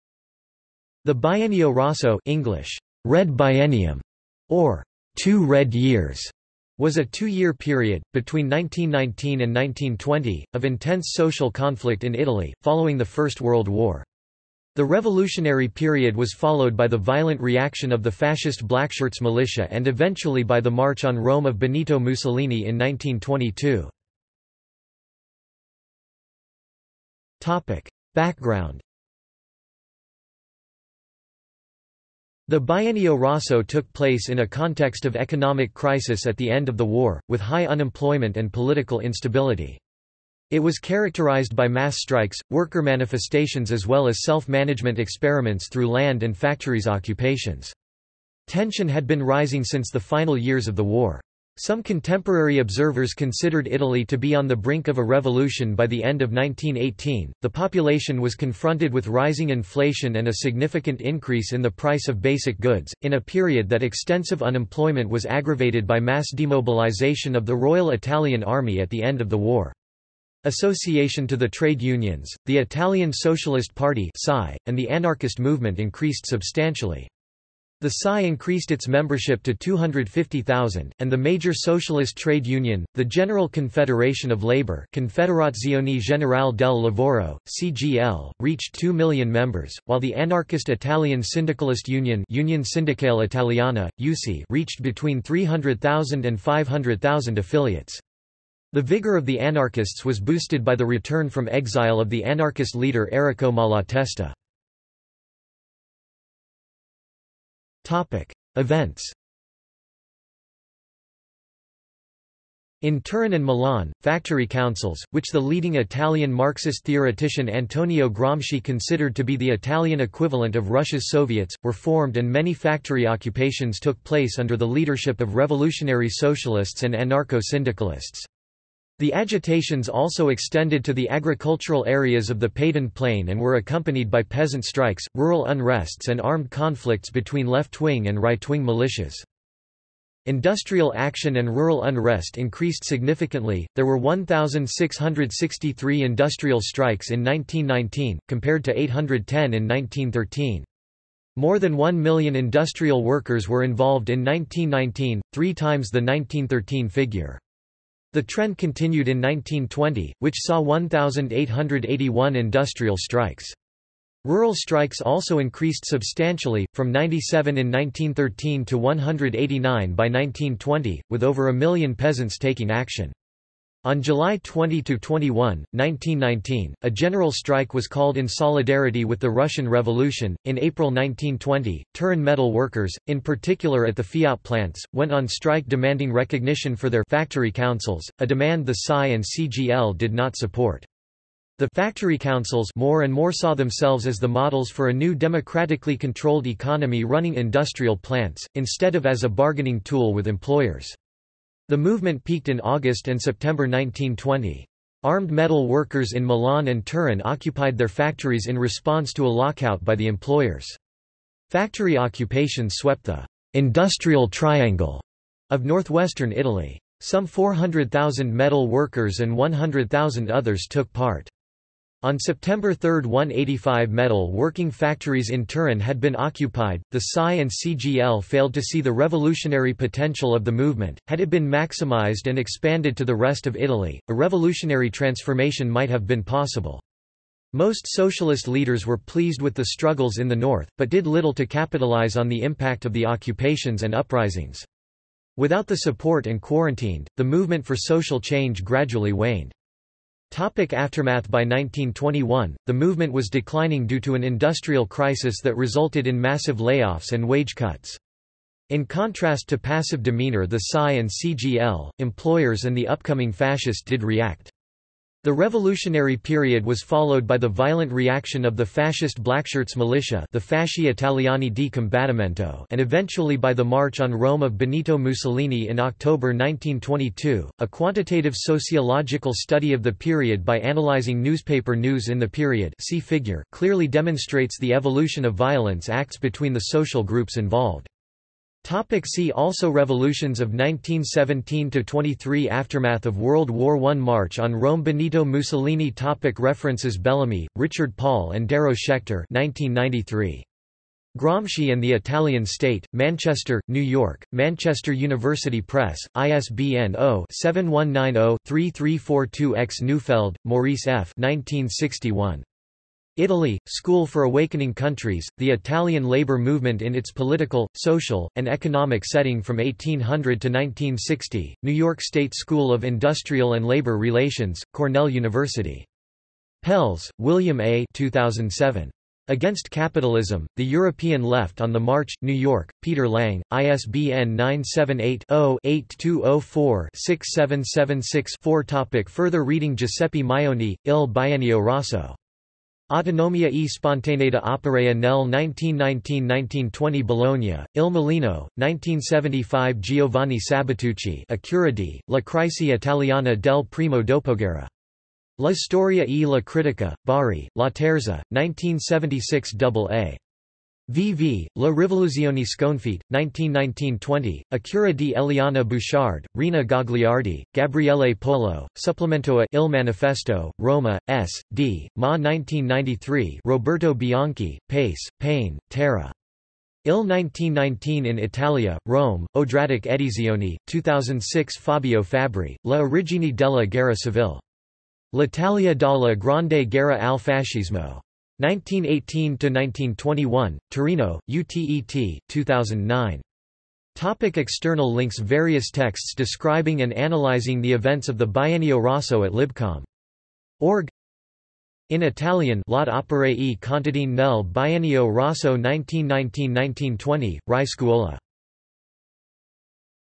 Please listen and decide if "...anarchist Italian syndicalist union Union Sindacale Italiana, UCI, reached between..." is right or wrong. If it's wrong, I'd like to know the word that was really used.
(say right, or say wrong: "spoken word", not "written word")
right.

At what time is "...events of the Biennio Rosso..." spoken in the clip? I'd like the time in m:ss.
6:37.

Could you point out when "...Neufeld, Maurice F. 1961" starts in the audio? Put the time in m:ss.
5:09.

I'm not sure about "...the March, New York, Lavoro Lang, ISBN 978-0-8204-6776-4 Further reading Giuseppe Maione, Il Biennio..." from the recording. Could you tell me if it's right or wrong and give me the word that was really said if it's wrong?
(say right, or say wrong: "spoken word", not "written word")
wrong: "Peter", not "Lavoro".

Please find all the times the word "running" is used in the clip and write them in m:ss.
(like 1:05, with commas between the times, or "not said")
3:17.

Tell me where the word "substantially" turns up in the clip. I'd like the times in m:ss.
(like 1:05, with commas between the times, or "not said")
1:16, 2:45.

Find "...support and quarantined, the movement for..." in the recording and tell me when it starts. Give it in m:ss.
4:05.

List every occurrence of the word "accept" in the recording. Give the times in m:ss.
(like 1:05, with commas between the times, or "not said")
not said.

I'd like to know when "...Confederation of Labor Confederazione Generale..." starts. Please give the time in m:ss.
1:23.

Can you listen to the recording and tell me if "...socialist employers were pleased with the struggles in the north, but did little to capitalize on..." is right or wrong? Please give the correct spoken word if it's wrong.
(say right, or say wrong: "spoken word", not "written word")
wrong: "leaders", not "employers".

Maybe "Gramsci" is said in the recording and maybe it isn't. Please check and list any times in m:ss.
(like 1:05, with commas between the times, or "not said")
1:58, 5:01.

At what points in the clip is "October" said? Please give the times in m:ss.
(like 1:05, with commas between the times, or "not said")
4:35.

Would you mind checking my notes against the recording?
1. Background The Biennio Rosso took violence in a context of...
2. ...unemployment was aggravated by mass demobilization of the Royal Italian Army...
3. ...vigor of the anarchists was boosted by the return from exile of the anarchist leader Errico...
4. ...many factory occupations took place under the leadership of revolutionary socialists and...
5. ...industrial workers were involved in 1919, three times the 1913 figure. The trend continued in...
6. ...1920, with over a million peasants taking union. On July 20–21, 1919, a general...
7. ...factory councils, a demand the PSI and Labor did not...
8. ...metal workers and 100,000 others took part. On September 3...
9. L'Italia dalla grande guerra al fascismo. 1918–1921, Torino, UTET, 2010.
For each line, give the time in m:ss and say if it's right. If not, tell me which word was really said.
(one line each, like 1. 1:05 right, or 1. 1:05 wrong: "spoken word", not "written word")
1. 0:28 wrong: "place", not "violence"
2. 1:04 right
3. 1:38 right
4. 2:02 right
5. 2:32 right
6. 2:50 wrong: "action", not "union"
7. 3:07 wrong: "CGL", not "Labor"
8. 3:38 right
9. 6:25 wrong: "2009", not "2010".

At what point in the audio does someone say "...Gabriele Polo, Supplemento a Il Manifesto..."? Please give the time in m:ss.
6:07.